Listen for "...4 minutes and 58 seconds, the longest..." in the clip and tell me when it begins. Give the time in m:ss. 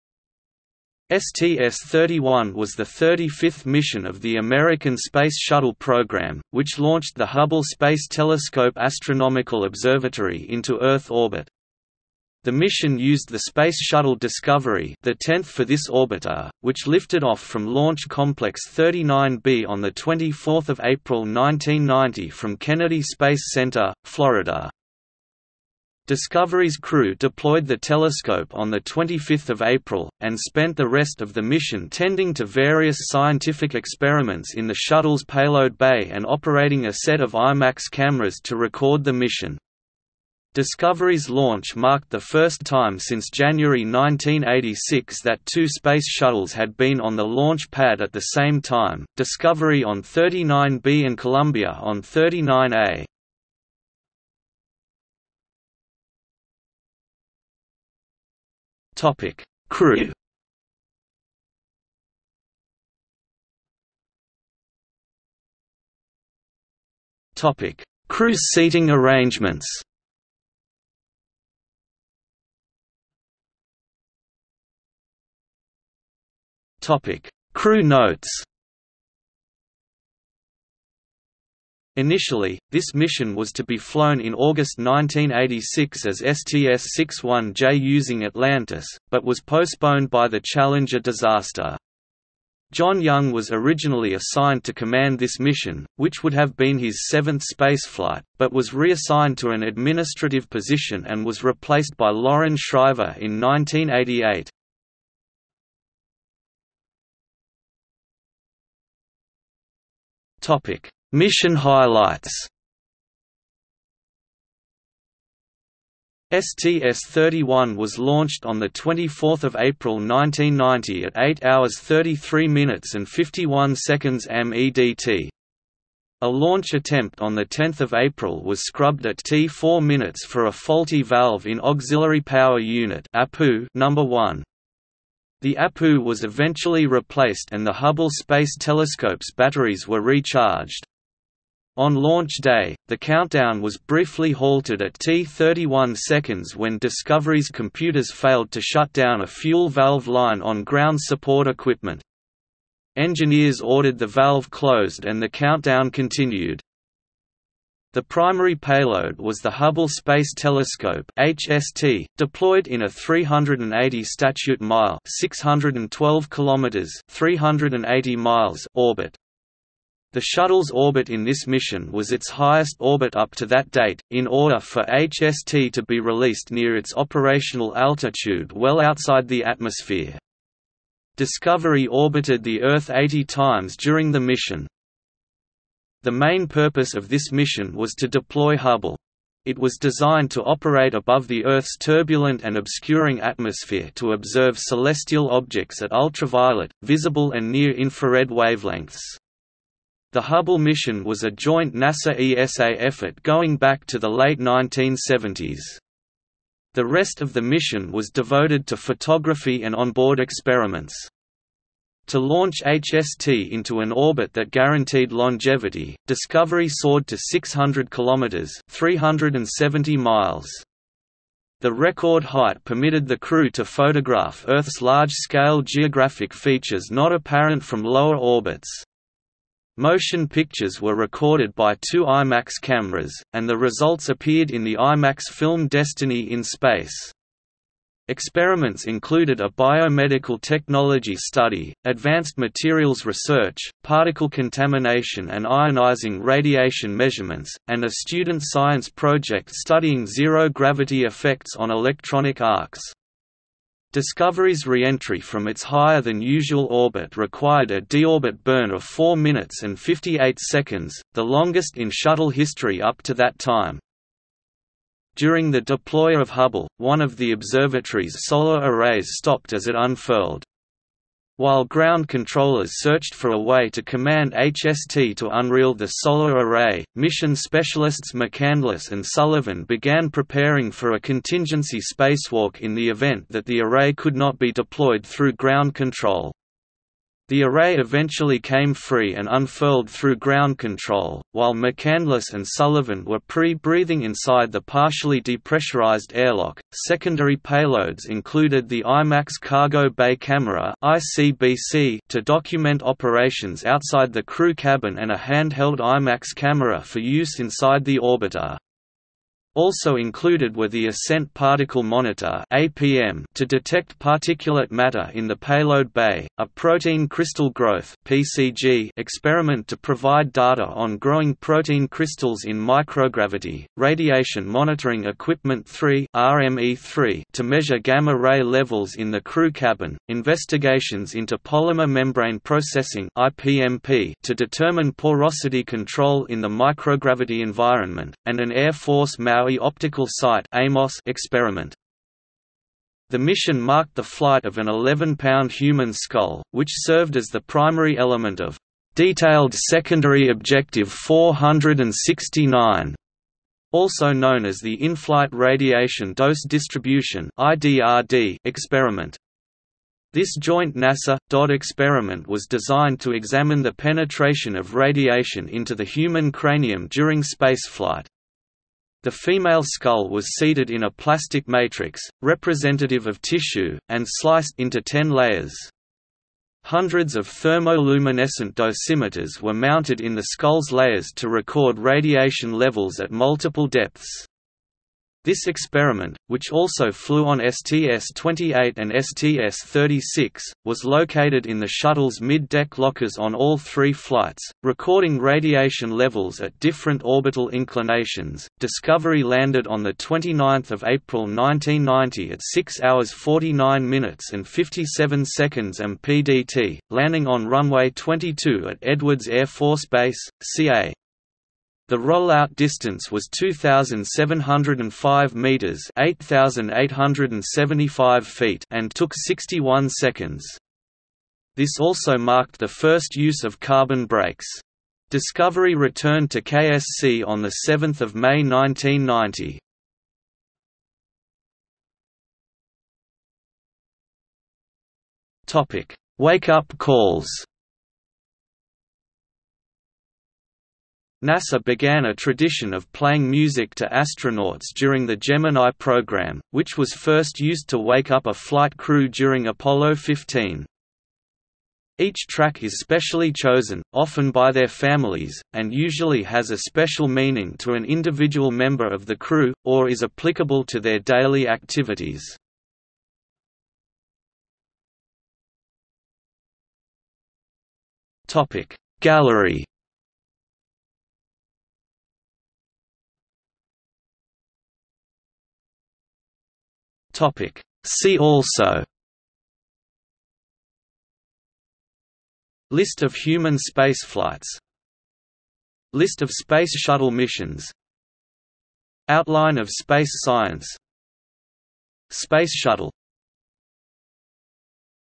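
4:18.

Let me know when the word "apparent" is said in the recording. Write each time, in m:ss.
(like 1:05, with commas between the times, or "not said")
3:47.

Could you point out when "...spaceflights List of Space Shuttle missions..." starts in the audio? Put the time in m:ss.
8:03.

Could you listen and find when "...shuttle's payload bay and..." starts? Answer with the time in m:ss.
0:34.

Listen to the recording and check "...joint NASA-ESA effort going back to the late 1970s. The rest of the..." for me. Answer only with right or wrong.
right.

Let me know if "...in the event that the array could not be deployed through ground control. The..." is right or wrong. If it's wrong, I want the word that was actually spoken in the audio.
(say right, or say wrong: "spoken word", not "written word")
right.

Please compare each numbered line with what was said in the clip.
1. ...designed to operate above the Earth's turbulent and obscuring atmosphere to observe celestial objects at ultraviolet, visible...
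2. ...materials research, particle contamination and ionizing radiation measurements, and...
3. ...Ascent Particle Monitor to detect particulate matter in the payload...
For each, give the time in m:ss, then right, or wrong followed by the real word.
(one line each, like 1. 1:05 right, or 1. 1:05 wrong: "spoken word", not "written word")
1. 3:09 right
2. 4:02 right
3. 5:10 right.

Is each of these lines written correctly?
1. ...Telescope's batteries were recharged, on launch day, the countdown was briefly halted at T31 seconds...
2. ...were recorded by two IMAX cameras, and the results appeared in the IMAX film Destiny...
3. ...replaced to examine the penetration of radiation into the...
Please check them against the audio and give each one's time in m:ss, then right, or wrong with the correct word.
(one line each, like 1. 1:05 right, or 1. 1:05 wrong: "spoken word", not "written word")
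1. 2:18 right
2. 3:50 right
3. 6:02 wrong: "designed", not "replaced".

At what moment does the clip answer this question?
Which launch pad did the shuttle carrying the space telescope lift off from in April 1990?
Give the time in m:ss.
0:17.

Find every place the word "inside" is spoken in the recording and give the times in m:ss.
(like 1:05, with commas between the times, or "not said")
4:54, 5:07.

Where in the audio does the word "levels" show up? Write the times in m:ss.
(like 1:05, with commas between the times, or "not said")
5:28, 6:22, 6:35.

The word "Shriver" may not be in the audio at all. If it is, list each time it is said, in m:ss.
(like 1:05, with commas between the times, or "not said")
1:42.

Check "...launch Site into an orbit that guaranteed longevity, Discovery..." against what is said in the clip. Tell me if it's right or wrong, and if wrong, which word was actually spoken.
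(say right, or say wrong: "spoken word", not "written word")
wrong: "HST", not "Site".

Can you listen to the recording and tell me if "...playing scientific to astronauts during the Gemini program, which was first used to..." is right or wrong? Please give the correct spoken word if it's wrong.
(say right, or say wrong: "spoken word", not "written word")
wrong: "music", not "scientific".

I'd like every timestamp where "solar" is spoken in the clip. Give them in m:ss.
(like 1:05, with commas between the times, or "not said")
4:28, 4:35.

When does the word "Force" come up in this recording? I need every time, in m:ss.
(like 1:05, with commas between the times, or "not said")
5:38, 6:49.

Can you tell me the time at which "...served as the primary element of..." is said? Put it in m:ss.
5:46.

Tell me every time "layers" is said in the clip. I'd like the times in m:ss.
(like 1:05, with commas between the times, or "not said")
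6:15, 6:20.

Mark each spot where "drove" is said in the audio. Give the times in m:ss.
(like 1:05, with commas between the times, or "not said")
not said.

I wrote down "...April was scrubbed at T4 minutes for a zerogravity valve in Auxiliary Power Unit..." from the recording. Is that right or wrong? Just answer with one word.
wrong.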